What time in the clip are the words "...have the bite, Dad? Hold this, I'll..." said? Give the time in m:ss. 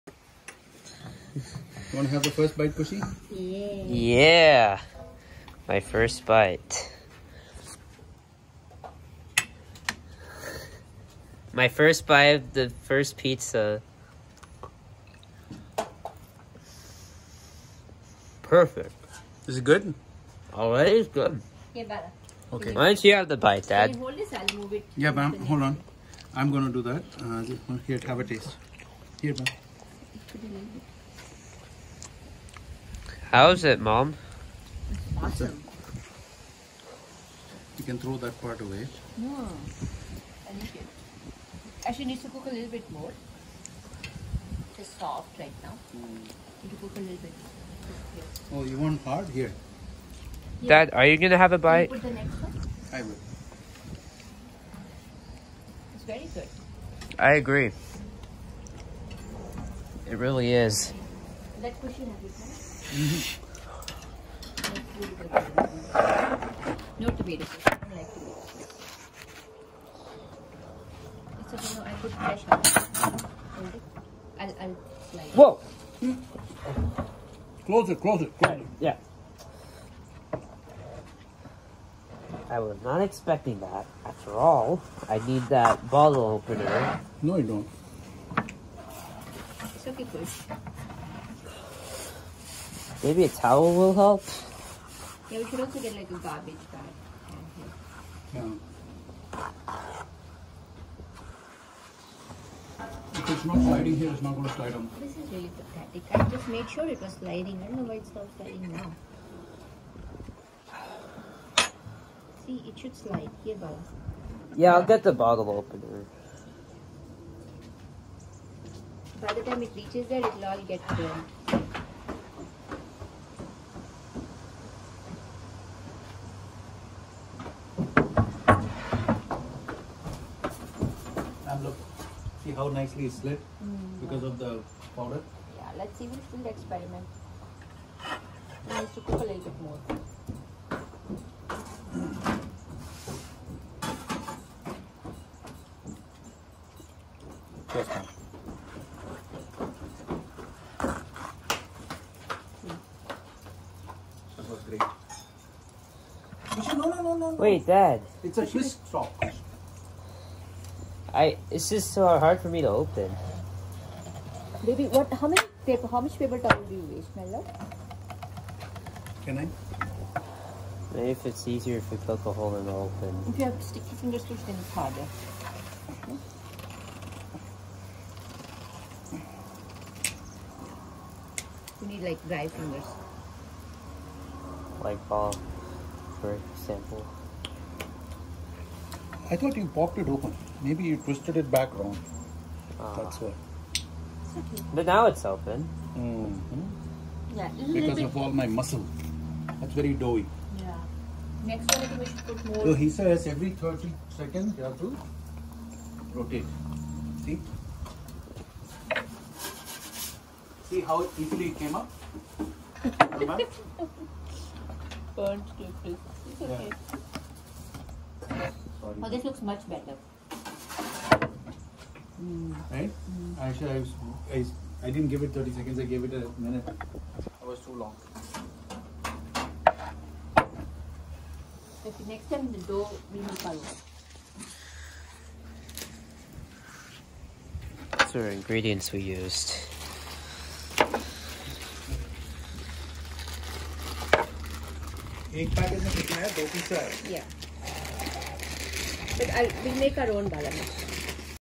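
0:23.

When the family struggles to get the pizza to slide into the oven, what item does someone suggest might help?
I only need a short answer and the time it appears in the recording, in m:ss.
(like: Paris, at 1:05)
A towel, at 1:33.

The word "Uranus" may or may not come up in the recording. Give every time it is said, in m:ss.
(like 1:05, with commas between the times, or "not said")
not said.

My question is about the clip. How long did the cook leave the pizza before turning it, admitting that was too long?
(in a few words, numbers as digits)
A minute.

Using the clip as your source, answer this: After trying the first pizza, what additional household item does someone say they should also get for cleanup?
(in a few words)
A garbage bag.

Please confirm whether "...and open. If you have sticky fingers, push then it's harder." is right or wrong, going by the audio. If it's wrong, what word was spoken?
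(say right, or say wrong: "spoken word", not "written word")
right.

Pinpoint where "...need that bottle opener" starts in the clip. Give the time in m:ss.
1:25.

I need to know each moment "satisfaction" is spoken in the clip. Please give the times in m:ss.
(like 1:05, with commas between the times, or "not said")
not said.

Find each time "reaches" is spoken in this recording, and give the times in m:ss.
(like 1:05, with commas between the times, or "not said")
1:59.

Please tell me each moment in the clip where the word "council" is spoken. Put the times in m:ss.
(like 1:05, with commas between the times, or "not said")
not said.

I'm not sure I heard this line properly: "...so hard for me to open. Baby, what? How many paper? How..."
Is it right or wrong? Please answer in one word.
right.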